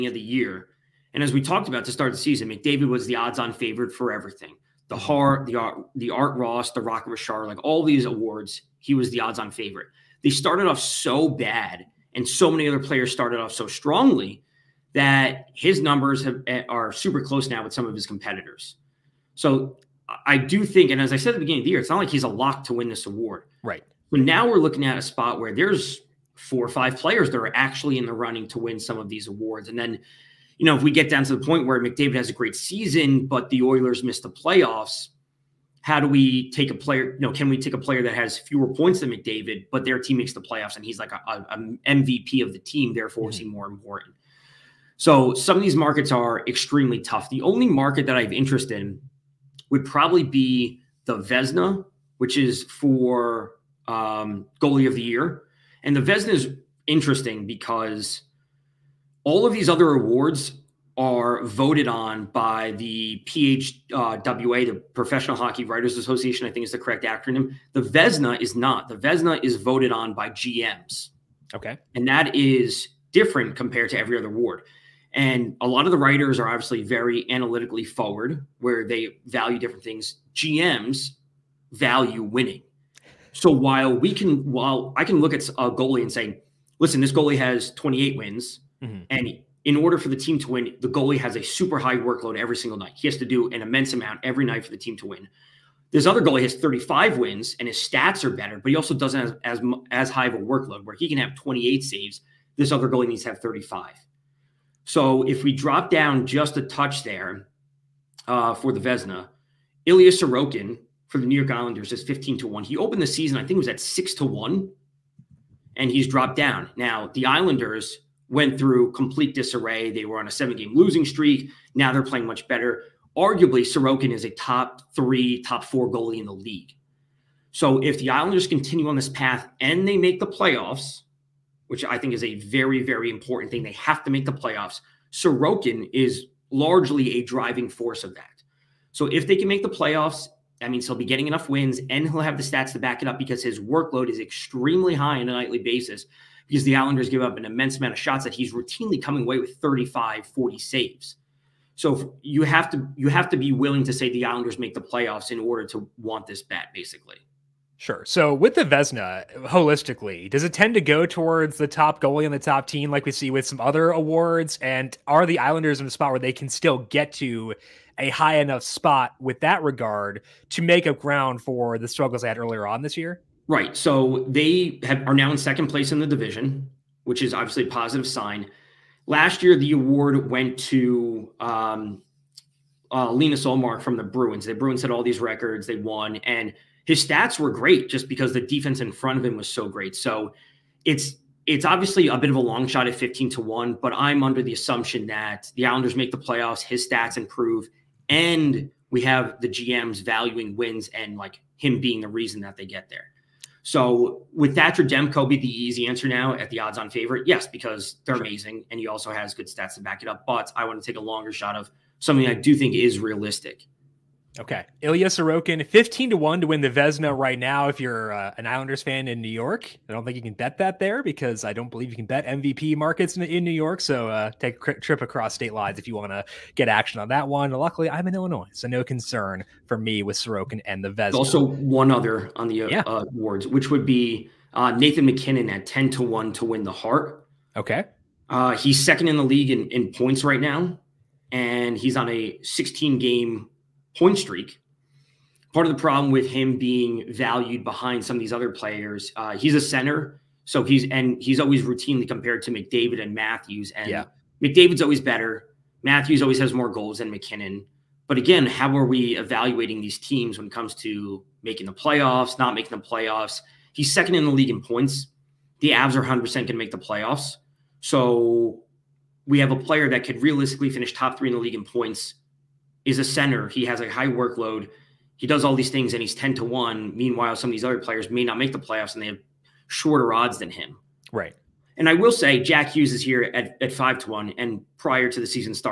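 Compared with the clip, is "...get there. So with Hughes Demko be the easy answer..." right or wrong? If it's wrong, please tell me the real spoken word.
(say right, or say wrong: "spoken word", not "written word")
wrong: "Thatcher", not "Hughes".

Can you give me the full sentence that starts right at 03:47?
Luckily, I'm in Illinois, so no concern for me with Sorokin and the Vezina.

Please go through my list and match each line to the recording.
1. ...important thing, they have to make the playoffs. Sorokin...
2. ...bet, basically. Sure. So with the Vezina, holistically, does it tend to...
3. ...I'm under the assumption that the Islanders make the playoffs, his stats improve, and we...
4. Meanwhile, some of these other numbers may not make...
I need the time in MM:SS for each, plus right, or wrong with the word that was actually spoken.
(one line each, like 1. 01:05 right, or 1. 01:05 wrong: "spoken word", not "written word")
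1. 02:13 right
2. 02:36 right
3. 03:13 right
4. 04:36 wrong: "players", not "numbers".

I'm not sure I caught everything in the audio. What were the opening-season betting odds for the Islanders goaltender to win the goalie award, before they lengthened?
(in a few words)
6 to 1.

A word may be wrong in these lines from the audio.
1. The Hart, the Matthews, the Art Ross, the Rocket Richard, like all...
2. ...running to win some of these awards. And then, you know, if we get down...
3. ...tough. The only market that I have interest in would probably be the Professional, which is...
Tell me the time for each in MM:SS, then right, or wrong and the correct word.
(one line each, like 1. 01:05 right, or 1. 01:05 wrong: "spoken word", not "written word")
1. 00:04 wrong: "Art", not "Matthews"
2. 00:28 right
3. 00:46 wrong: "Vezina", not "Professional".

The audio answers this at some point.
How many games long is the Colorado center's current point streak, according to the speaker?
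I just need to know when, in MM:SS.
04:02.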